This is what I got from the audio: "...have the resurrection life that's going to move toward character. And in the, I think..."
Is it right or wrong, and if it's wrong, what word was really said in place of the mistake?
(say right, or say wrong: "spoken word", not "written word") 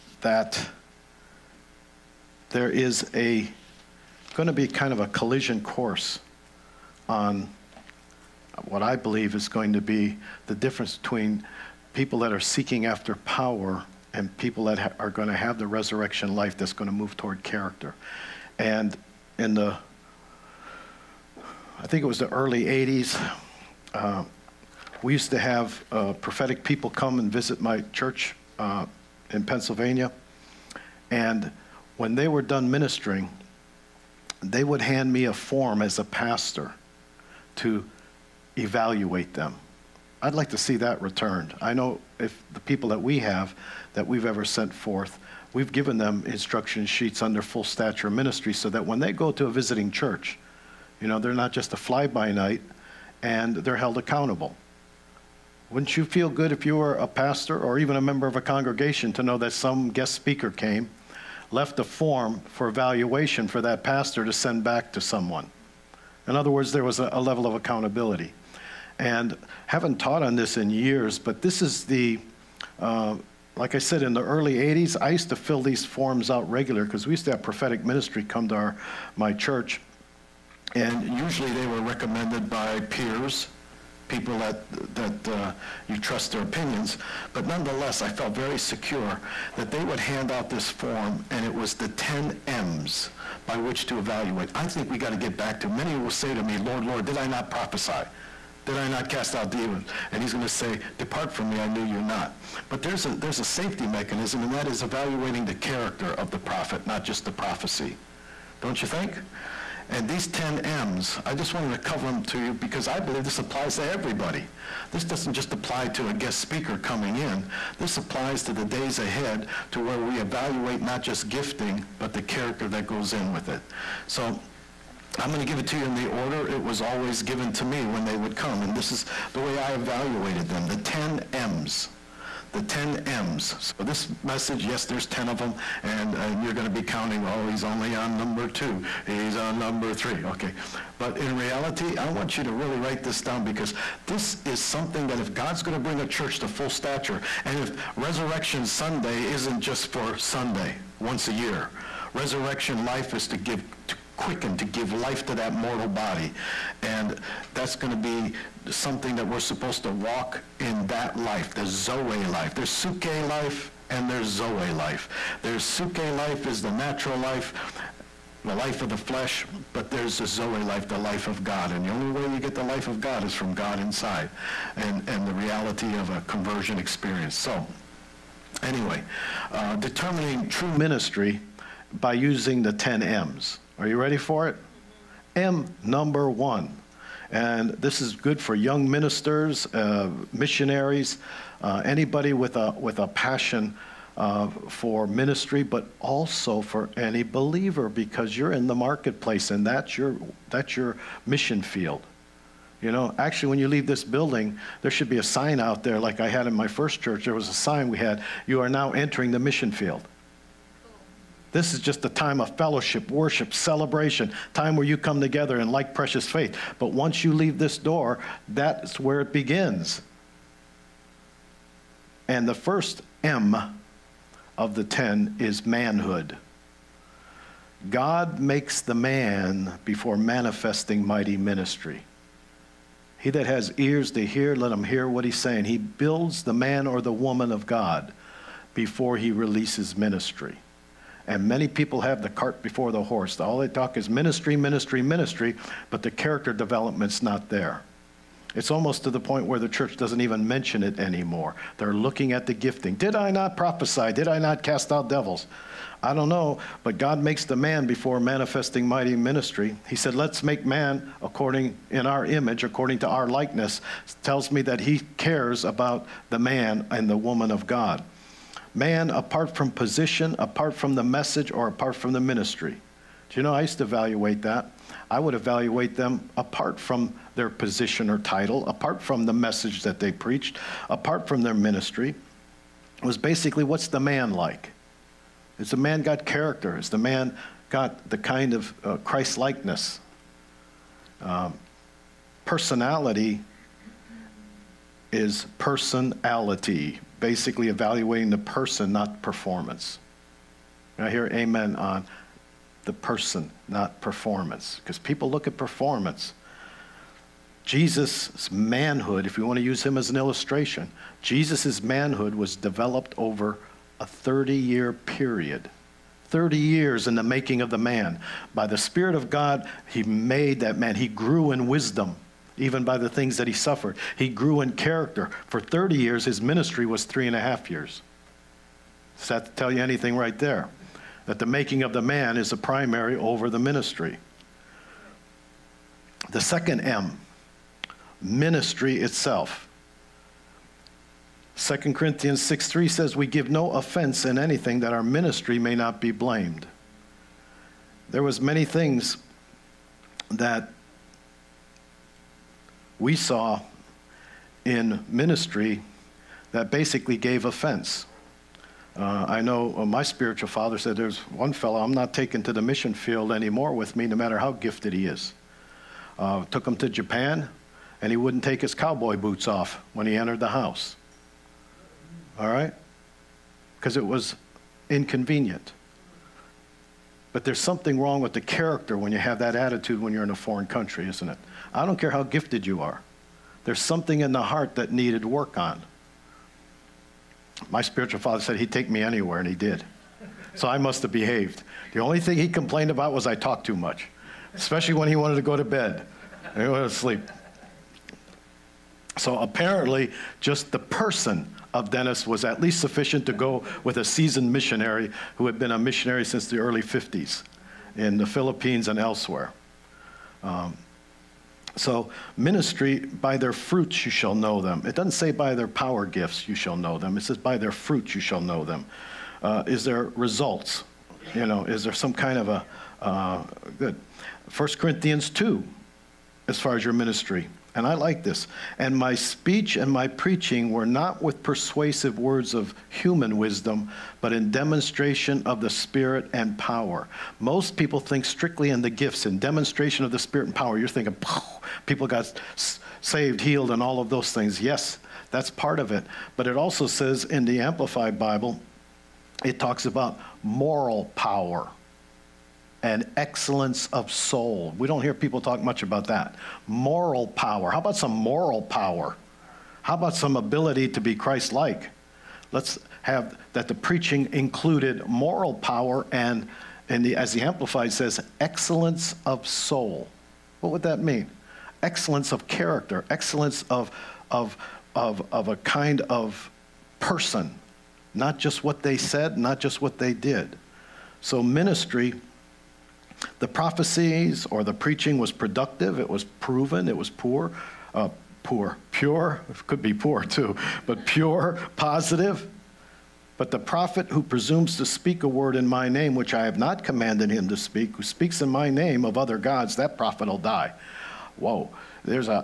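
right.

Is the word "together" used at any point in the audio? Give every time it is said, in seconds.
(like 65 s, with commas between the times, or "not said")
215 s.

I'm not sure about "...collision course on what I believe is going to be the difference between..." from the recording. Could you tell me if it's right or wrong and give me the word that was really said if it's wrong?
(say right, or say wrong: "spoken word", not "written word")
right.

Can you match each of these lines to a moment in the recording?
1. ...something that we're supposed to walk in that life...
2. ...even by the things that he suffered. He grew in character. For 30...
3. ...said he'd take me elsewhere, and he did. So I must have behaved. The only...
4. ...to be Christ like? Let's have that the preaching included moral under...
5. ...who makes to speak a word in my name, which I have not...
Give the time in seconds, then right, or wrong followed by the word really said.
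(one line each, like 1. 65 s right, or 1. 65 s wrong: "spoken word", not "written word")
1. 158 s right
2. 322 s right
3. 388 s wrong: "anywhere", not "elsewhere"
4. 460 s wrong: "power", not "under"
5. 494 s wrong: "presumes", not "makes".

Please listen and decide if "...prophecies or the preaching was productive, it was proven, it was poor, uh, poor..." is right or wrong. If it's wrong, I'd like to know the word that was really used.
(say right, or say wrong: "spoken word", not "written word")
right.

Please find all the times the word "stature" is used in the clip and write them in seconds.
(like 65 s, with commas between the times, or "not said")
47 s, 146 s.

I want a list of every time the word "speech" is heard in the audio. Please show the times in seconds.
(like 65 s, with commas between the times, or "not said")
429 s.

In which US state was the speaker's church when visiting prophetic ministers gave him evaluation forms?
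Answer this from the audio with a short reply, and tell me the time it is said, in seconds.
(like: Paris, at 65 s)
Pennsylvania, at 29 s.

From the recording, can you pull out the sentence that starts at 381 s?
I don't care how gifted you are.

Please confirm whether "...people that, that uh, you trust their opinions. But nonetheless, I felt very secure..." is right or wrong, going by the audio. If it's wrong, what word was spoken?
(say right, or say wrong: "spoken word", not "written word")
right.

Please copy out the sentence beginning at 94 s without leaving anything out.
I think we got to get back to many will say to me, Lord, Lord, did I not prophesy?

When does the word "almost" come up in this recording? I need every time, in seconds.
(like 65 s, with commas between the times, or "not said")
248 s.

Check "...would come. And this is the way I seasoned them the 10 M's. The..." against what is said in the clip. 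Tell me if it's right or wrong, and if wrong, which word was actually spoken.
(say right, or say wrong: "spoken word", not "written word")
wrong: "evaluated", not "seasoned".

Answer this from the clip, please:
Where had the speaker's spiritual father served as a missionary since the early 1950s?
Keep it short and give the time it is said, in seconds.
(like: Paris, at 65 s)
The Philippines, at 408 s.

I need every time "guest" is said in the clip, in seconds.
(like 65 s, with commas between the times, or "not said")
59 s, 116 s.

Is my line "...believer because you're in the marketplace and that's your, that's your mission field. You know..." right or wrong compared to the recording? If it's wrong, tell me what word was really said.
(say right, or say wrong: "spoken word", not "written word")
right.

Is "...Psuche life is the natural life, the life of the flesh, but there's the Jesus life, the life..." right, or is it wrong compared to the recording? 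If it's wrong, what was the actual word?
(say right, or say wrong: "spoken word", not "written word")
wrong: "Zoe", not "Jesus".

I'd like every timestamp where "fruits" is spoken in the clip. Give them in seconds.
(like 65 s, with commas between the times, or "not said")
413 s, 417 s.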